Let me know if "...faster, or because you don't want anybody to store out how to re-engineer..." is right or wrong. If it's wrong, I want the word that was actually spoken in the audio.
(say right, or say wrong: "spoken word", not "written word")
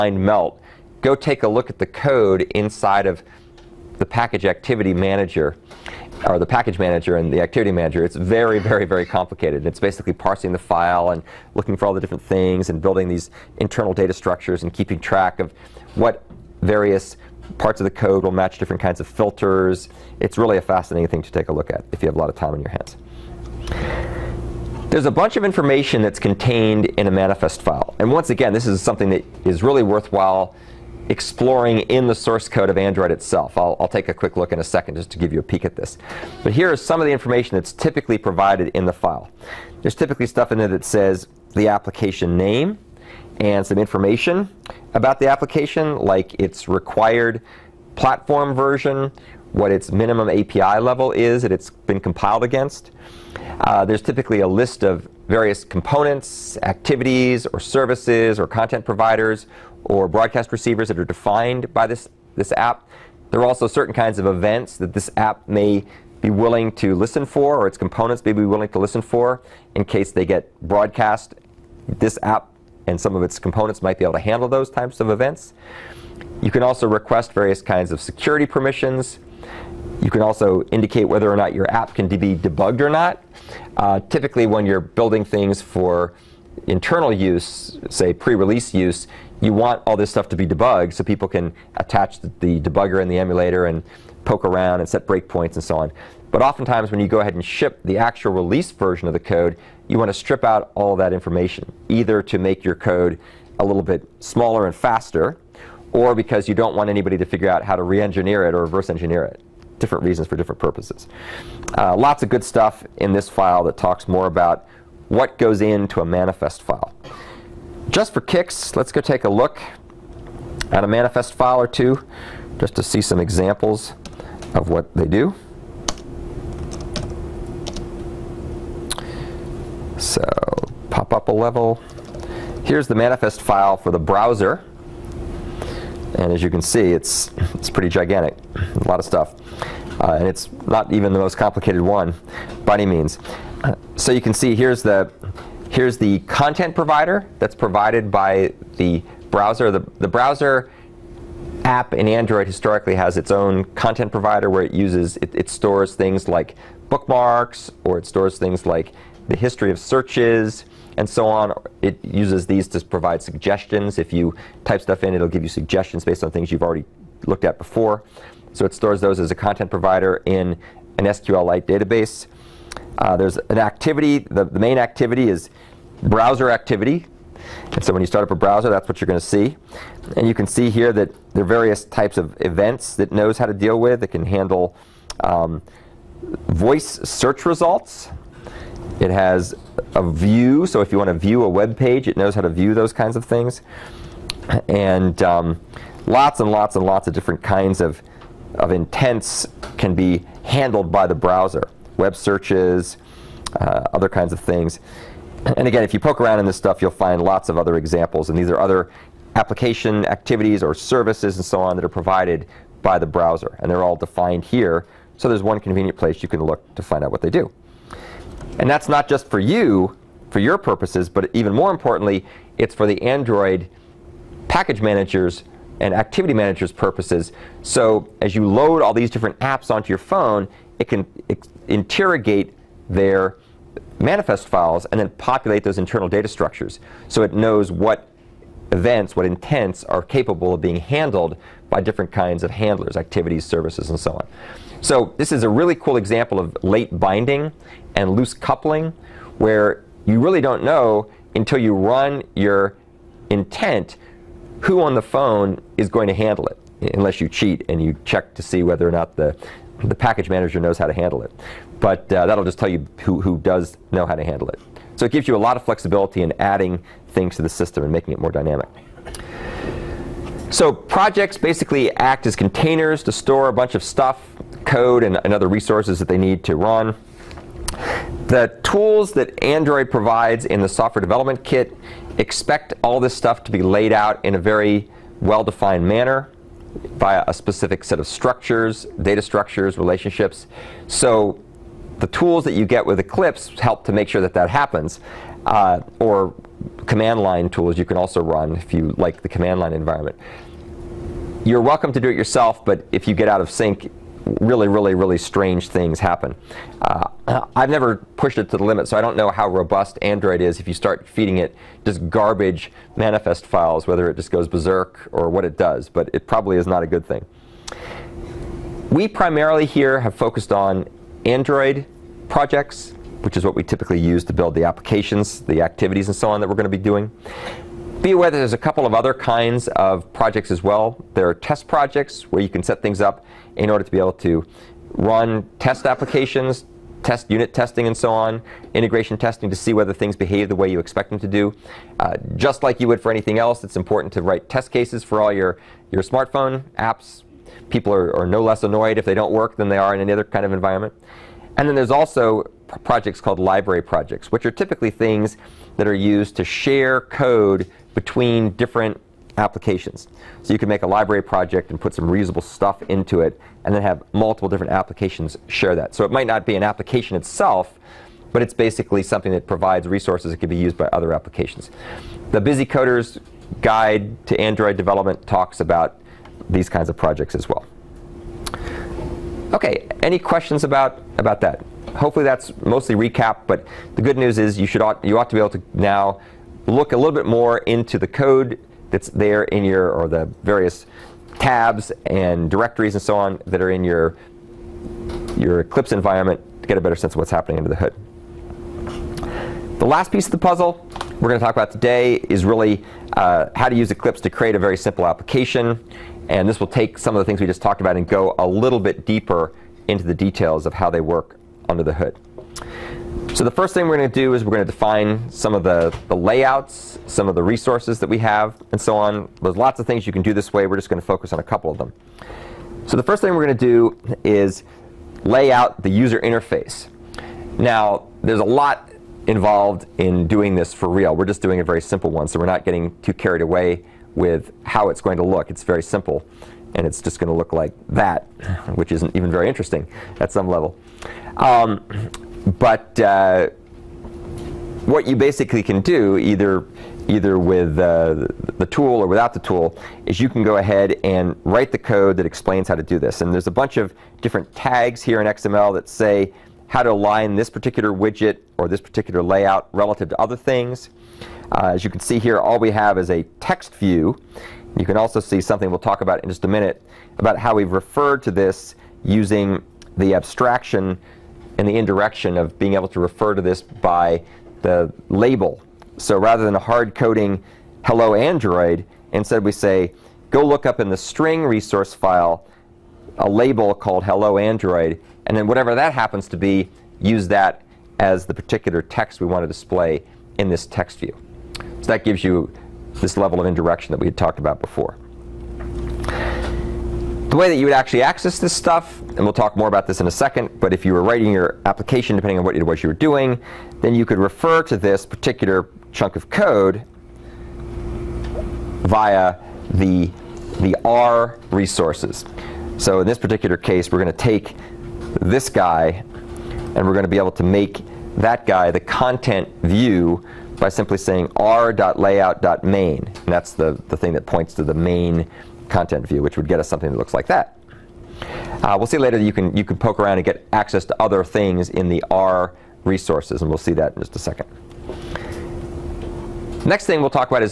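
wrong: "figure", not "store".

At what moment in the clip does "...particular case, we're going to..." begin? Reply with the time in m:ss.
8:33.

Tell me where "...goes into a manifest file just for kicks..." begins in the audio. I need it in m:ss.
1:55.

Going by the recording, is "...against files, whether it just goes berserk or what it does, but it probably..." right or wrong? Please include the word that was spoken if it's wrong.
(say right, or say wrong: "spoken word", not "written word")
wrong: "manifest", not "against".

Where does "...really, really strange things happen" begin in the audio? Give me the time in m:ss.
5:04.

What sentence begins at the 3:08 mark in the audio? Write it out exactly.
It has a view, so if you want to view a web page, it knows how to view those kinds of things.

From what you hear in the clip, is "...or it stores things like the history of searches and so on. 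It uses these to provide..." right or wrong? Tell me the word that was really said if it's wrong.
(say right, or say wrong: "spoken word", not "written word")
right.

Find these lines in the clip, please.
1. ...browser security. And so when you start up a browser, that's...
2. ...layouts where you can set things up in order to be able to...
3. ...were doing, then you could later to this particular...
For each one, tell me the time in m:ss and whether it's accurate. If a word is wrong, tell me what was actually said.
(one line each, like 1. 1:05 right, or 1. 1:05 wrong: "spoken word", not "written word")
1. 2:56 wrong: "activity", not "security"
2. 5:31 wrong: "projects", not "layouts"
3. 8:22 wrong: "refer", not "later".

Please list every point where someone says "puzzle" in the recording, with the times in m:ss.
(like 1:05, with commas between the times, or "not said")
6:40.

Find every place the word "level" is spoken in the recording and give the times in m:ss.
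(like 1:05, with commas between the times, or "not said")
0:50, 2:11, 7:20, 8:13.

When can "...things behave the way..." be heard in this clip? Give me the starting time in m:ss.
5:39.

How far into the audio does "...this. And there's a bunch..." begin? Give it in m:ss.
7:32.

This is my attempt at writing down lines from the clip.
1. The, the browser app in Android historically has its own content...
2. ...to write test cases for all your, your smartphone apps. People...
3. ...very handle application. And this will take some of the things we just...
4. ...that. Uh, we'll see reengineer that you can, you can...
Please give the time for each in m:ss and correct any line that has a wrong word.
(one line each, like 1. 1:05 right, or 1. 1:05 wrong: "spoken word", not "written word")
1. 2:29 right
2. 5:44 right
3. 6:44 wrong: "simple", not "handle"
4. 8:47 wrong: "later", not "reengineer".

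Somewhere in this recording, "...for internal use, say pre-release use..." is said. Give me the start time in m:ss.
1:25.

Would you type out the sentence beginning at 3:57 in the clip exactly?
So it knows what events, what intents are capable of being handled by different kinds of handlers, activities, services, and so on.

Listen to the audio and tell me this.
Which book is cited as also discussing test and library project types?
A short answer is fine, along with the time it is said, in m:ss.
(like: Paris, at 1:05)
The Busy Coders Guide to Android Development, at 6:12.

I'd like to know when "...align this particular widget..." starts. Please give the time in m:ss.
7:36.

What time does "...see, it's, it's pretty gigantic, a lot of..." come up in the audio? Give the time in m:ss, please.
2:16.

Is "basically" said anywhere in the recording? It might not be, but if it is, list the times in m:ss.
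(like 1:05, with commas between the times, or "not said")
0:09, 4:31, 6:08, 7:25.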